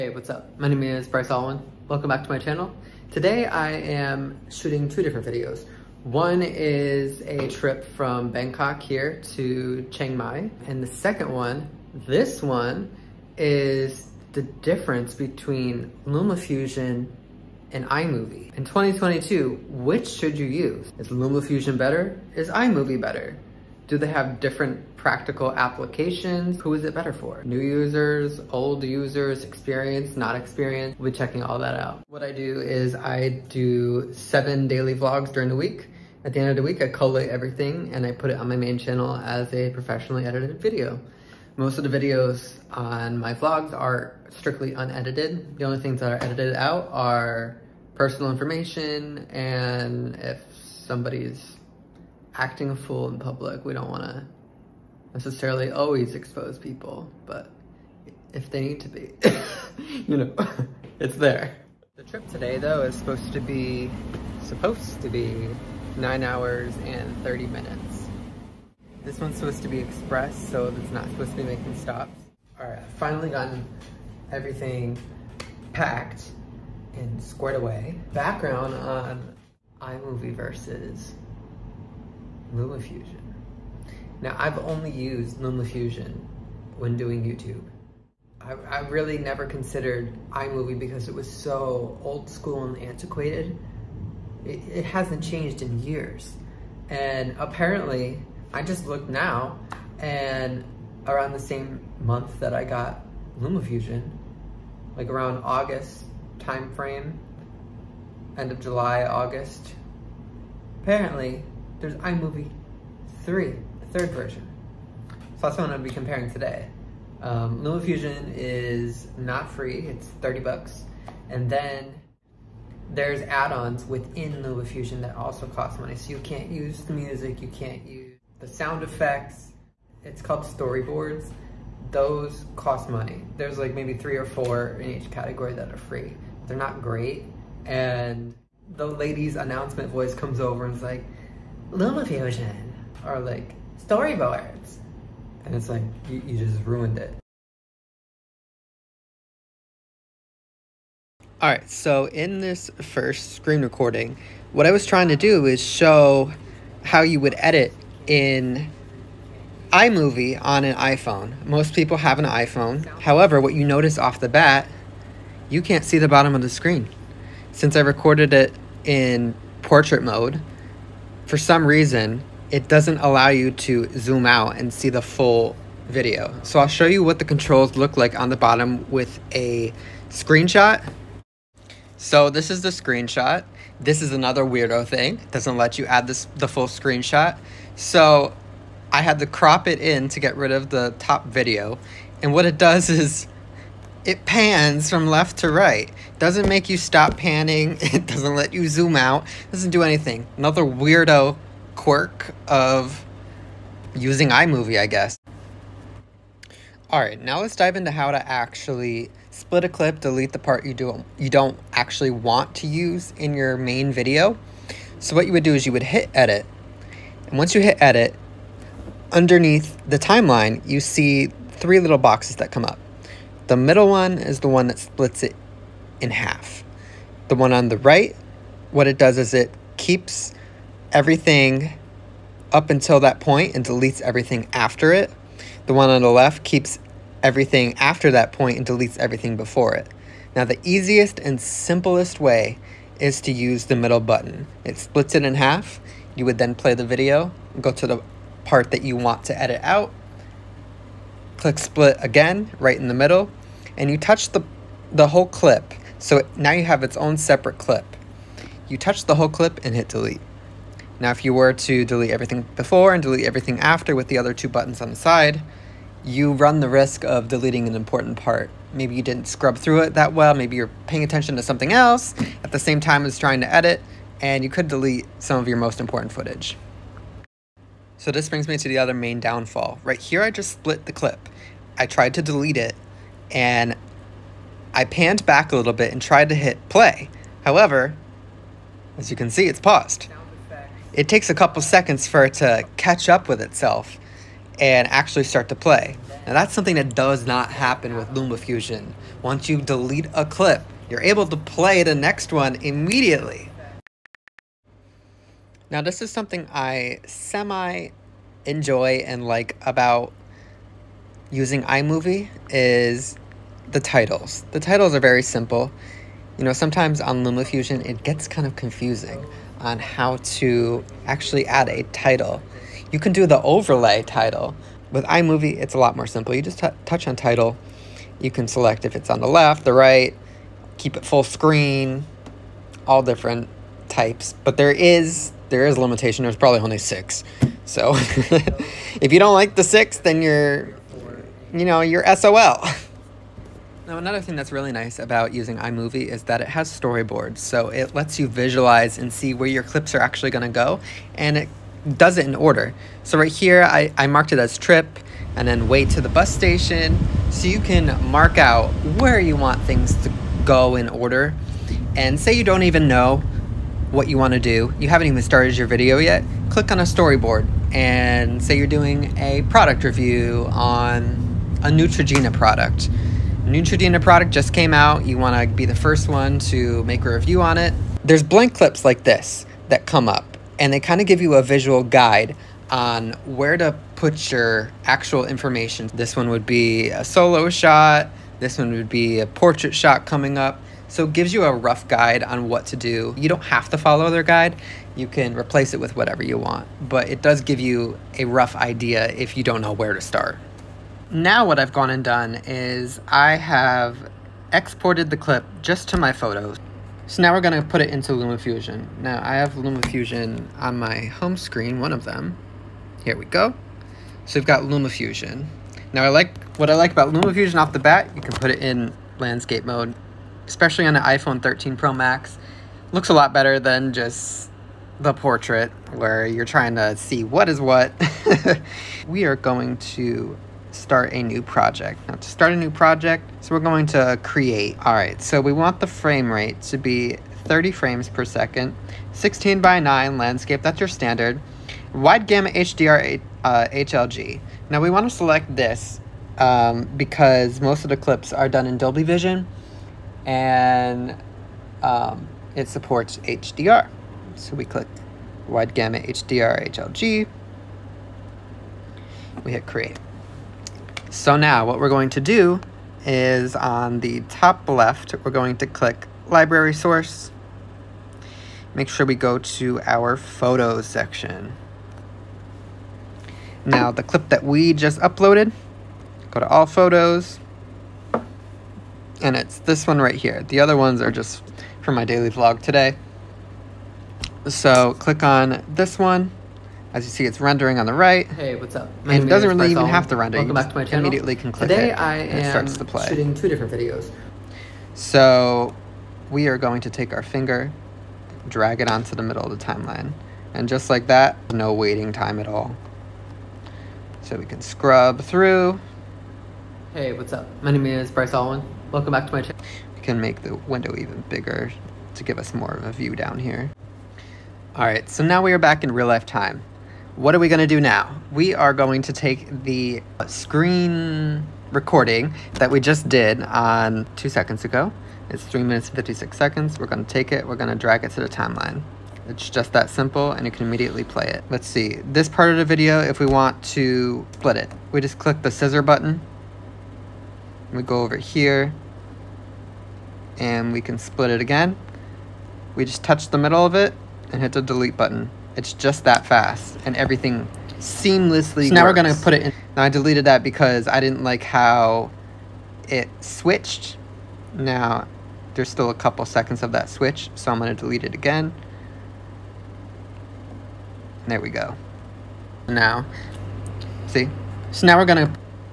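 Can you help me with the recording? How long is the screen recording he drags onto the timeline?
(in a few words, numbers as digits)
3 minutes 56 seconds.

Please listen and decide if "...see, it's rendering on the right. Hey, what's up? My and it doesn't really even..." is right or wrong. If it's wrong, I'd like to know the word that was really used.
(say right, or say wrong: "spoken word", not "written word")
right.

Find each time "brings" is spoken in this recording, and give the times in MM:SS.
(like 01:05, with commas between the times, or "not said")
04:38.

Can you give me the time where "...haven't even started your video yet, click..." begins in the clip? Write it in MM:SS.
06:04.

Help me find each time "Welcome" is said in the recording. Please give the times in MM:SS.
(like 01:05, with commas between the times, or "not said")
00:01, 08:10, 08:28.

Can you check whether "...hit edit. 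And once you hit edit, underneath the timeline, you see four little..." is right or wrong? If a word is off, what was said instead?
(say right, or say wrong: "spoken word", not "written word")
wrong: "three", not "four".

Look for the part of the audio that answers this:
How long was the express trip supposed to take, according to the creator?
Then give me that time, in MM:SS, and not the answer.
01:05.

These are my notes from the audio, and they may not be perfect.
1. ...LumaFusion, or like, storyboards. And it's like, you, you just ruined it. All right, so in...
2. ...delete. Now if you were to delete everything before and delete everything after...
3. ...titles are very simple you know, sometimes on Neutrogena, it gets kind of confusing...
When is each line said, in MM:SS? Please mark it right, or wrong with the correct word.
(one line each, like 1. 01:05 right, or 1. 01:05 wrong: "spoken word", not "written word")
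1. 02:21 right
2. 04:19 right
3. 05:14 wrong: "LumaFusion", not "Neutrogena".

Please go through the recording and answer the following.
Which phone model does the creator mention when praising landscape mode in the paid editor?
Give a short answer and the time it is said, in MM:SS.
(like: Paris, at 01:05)
iPhone 13 Pro Max, at 07:01.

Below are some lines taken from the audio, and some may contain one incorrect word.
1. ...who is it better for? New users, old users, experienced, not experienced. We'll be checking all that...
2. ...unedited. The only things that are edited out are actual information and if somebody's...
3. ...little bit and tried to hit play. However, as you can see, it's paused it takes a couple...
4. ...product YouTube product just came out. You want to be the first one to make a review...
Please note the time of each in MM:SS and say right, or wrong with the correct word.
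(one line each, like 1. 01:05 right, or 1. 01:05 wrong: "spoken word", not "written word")
1. 00:26 right
2. 00:44 wrong: "personal", not "actual"
3. 04:45 right
4. 06:12 wrong: "Neutrogena", not "YouTube".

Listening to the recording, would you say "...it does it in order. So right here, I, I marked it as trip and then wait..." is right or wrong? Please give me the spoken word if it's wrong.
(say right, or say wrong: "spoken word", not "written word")
right.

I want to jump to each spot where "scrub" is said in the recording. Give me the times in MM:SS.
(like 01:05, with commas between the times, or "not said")
04:29, 08:24.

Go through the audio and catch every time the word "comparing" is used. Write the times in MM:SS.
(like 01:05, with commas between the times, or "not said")
01:55.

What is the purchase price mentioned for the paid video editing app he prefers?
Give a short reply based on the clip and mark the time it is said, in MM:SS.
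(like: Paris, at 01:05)
$30, at 02:00.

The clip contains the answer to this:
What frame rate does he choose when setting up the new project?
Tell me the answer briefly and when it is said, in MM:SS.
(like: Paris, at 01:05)
30 frames per second, at 07:17.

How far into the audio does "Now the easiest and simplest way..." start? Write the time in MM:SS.
04:00.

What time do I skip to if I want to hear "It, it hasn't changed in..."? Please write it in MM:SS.
01:34.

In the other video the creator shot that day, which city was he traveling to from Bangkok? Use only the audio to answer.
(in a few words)
Chiang Mai.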